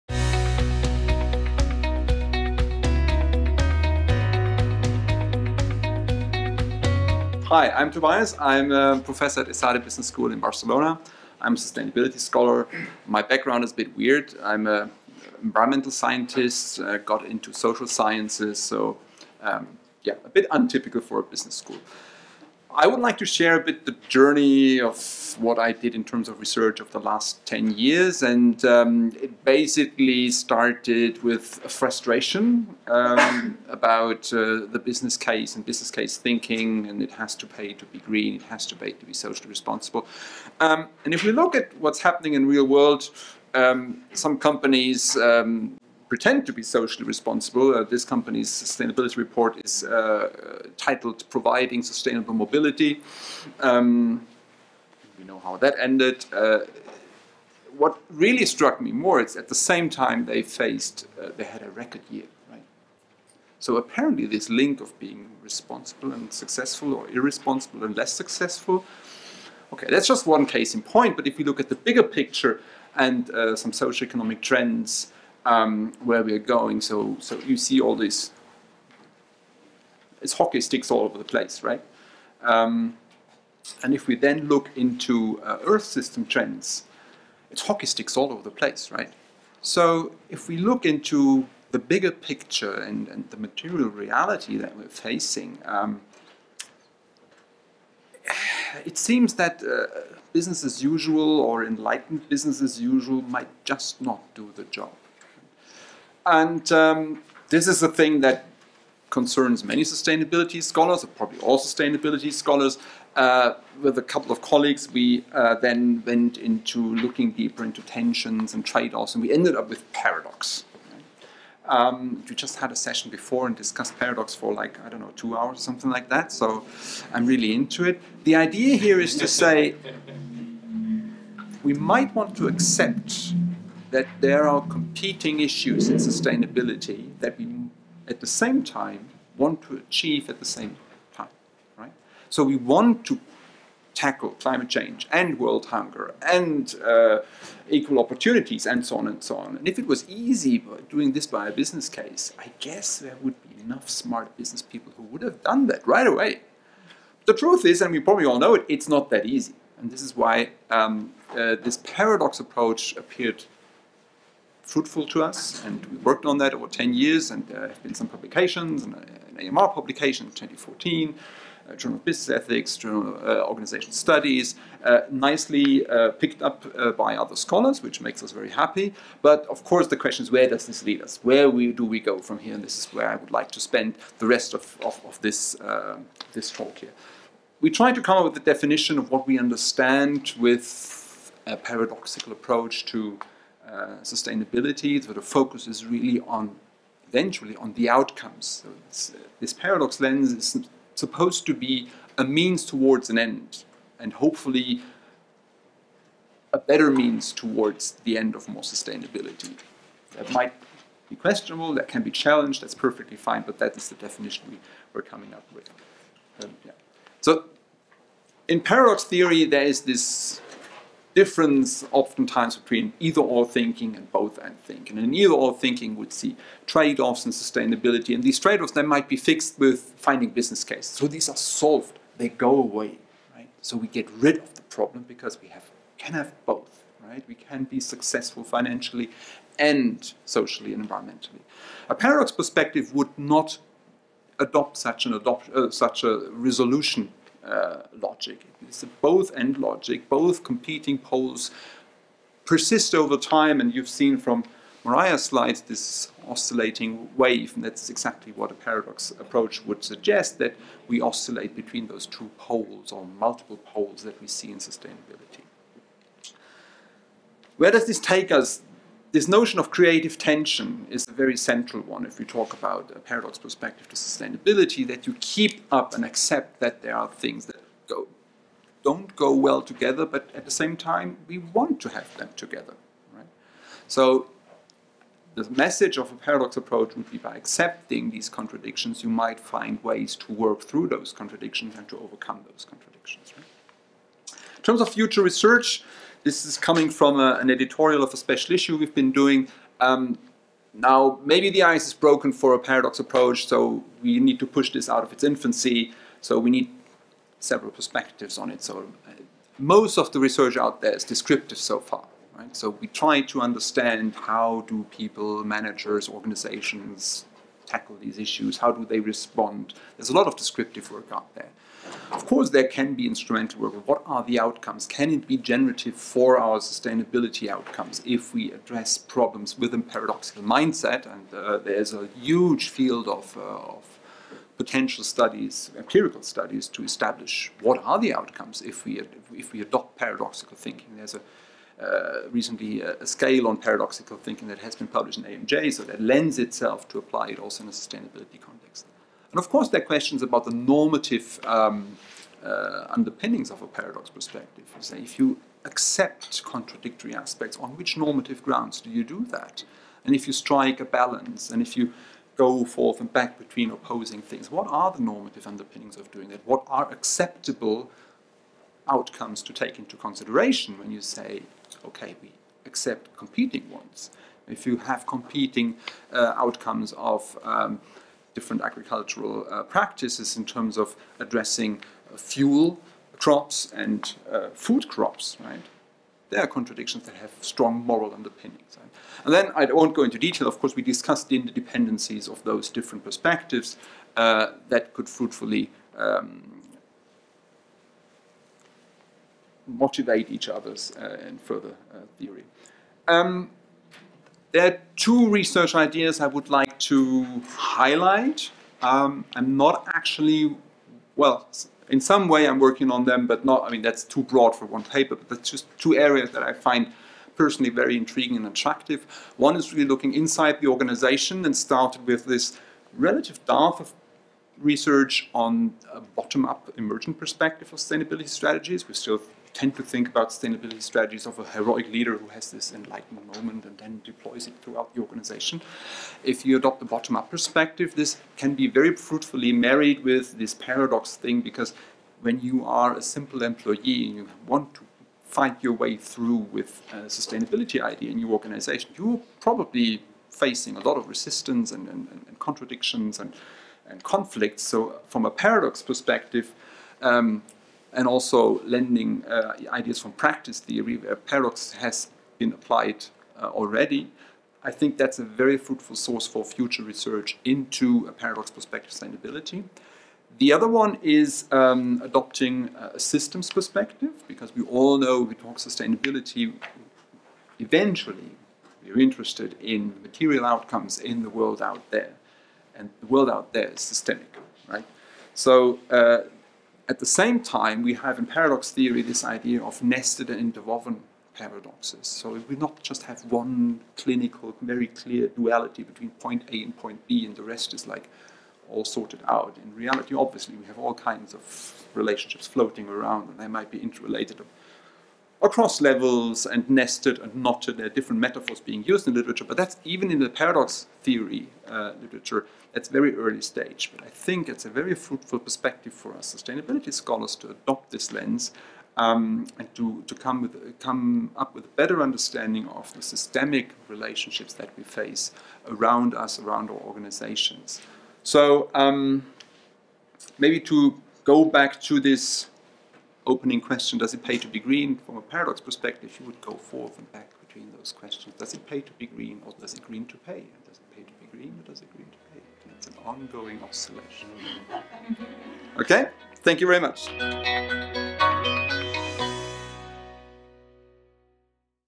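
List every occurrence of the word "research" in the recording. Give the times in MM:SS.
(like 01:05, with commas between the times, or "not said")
00:26, 04:55, 05:10, 06:45, 07:04, 07:46.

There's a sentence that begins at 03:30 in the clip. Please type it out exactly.
That might be questionable, that can be challenged, that's perfectly fine, but that is the definition we were coming up with.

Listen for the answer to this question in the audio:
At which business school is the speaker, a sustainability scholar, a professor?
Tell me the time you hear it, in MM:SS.
00:09.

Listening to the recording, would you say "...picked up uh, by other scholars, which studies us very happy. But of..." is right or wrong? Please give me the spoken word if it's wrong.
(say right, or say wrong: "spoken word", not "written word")
wrong: "makes", not "studies".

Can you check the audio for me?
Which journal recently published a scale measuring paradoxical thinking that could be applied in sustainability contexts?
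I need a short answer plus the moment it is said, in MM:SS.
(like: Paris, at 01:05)
AMJ, at 05:45.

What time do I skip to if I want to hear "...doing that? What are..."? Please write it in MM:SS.
06:06.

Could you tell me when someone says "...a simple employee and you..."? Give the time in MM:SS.
07:22.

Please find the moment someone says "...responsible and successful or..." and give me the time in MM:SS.
01:05.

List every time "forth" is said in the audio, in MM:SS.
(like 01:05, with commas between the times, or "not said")
06:02, 08:56.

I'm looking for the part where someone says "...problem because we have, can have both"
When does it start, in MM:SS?
03:54.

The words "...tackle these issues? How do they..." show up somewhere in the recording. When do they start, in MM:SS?
05:17.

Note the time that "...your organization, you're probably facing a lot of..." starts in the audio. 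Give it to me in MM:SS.
07:28.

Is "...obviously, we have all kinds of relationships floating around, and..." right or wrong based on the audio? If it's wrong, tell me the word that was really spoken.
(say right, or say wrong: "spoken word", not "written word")
right.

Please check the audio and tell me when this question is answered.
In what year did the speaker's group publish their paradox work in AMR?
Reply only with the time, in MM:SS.
02:50.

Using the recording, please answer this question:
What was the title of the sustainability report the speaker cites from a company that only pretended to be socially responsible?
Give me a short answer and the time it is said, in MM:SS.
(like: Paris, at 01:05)
Providing Sustainable Mobility, at 00:51.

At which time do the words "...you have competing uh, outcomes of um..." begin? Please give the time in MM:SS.
06:14.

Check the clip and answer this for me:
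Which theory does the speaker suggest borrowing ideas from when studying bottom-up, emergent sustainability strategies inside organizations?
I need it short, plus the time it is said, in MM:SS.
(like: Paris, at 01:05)
Practice theory, at 07:40.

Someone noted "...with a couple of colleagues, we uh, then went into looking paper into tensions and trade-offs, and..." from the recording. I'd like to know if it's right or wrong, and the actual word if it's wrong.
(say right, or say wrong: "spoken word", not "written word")
wrong: "deeper", not "paper".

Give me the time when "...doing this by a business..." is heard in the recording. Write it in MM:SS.
02:30.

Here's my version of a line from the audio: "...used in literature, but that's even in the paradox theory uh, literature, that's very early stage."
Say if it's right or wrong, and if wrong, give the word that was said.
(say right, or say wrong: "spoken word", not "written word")
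right.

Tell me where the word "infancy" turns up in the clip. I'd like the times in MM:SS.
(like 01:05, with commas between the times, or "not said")
05:05.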